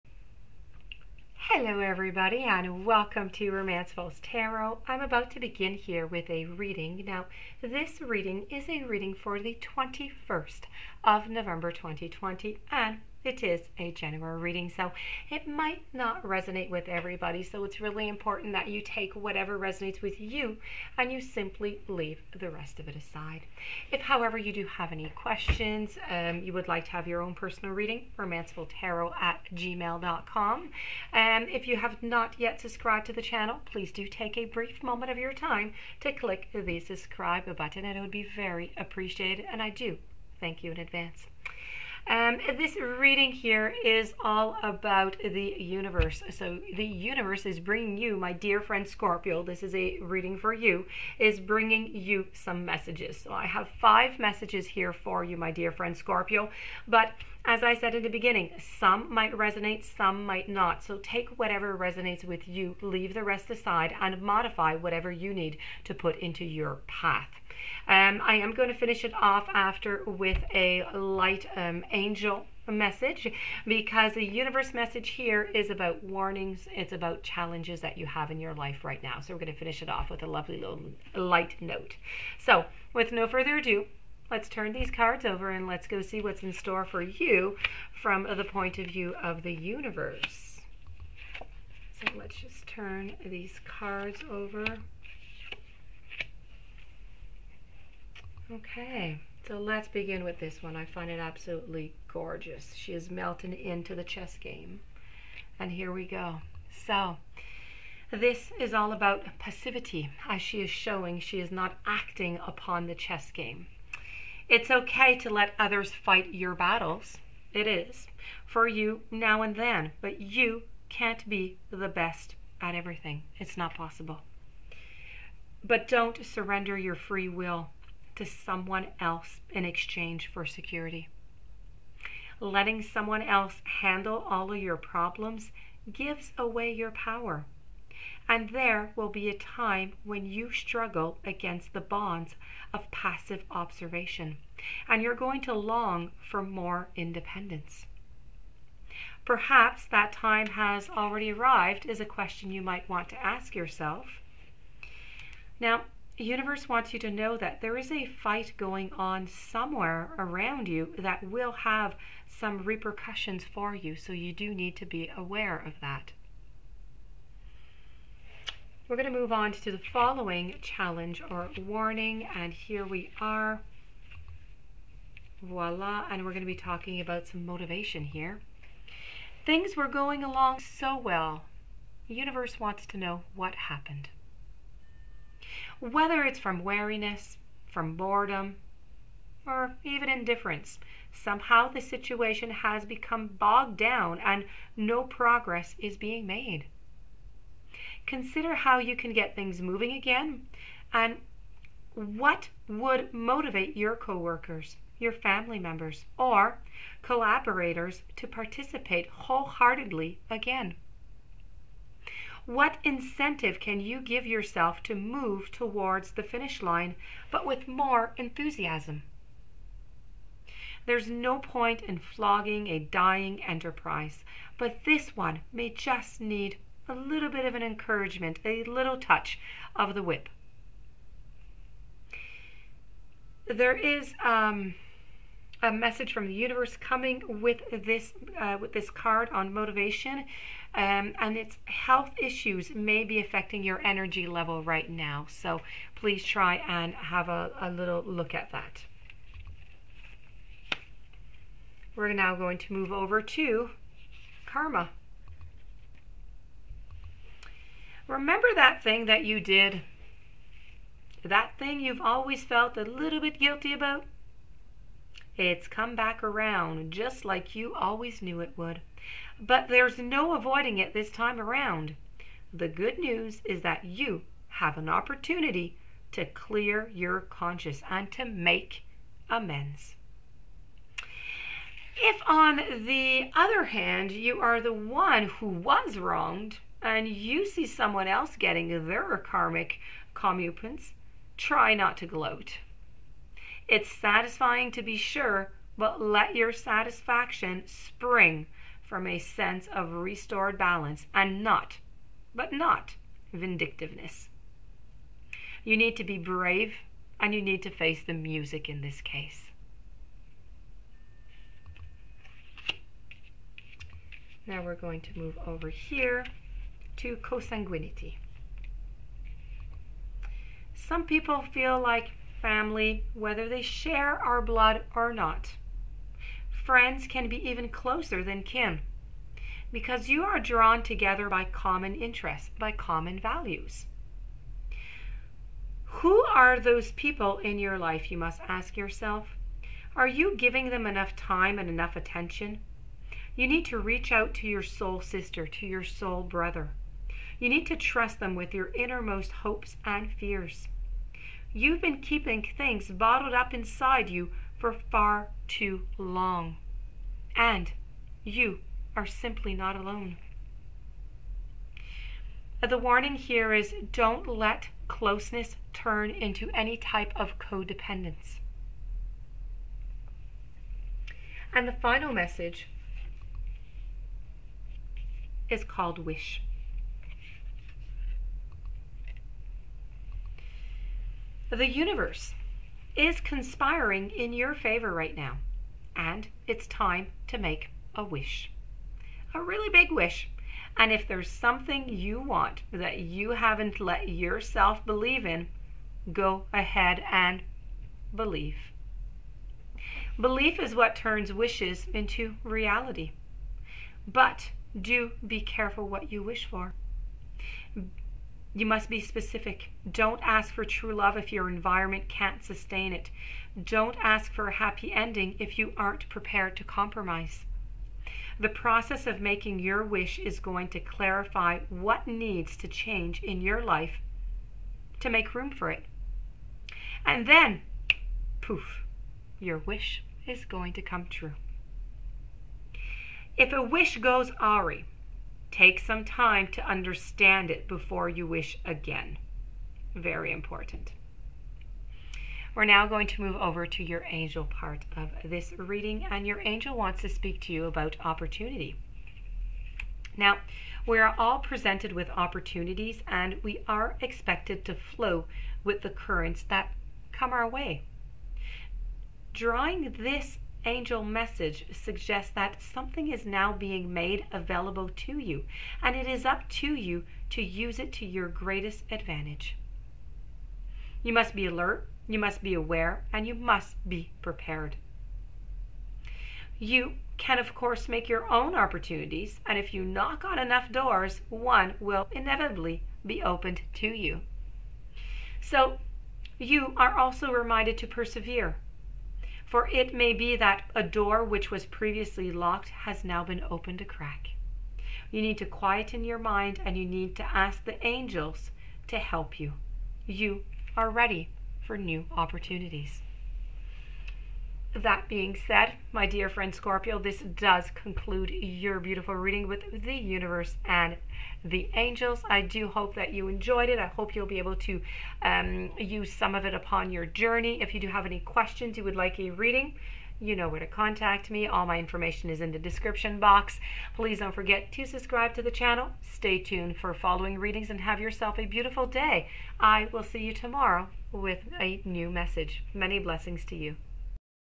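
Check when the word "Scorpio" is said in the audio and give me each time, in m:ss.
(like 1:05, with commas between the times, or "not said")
0:48, 0:55, 8:26.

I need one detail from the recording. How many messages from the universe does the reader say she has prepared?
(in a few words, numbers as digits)
5.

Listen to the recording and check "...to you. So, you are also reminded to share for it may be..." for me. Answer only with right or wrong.
wrong.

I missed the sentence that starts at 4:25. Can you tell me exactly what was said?
It's come back around, just like you always knew it would.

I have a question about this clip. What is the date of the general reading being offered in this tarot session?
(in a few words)
21 November 2020.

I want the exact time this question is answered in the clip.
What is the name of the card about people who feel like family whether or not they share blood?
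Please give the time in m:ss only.
5:17.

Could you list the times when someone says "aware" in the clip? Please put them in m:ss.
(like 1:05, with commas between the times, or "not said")
2:45, 7:52.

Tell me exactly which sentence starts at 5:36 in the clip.
Who are those people in your life, you must ask yourself?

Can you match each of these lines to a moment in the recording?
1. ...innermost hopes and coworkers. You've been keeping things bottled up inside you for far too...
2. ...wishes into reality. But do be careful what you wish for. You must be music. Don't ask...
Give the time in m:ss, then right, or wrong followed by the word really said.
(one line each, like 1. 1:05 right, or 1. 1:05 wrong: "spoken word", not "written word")
1. 5:48 wrong: "fears", not "coworkers"
2. 6:41 wrong: "specific", not "music".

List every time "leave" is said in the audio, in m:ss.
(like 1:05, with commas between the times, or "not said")
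0:21, 1:02.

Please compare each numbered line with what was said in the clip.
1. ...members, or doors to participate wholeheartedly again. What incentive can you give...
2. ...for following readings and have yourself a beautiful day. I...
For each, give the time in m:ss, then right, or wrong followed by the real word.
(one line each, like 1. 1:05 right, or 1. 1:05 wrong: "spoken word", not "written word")
1. 3:25 wrong: "collaborators", not "doors"
2. 8:46 right.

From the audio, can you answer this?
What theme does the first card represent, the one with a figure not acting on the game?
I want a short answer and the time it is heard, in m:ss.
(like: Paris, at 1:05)
passivity, at 1:49.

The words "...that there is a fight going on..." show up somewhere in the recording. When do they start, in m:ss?
2:37.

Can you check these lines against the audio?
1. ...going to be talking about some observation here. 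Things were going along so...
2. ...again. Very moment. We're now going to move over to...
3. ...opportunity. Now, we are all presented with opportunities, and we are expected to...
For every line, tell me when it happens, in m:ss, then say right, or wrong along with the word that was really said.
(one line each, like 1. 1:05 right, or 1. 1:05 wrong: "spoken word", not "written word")
1. 2:56 wrong: "motivation", not "observation"
2. 7:18 wrong: "important", not "moment"
3. 7:28 right.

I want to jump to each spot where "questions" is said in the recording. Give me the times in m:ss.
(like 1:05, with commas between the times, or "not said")
0:25, 2:32, 8:38.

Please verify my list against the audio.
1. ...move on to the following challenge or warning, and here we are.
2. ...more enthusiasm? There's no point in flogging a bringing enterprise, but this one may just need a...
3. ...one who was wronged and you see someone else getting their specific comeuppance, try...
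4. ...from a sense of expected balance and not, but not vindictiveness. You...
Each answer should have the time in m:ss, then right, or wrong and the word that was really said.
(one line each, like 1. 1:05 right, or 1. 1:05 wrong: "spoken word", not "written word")
1. 2:49 right
2. 3:37 wrong: "dying", not "bringing"
3. 4:44 wrong: "karmic", not "specific"
4. 4:58 wrong: "restored", not "expected".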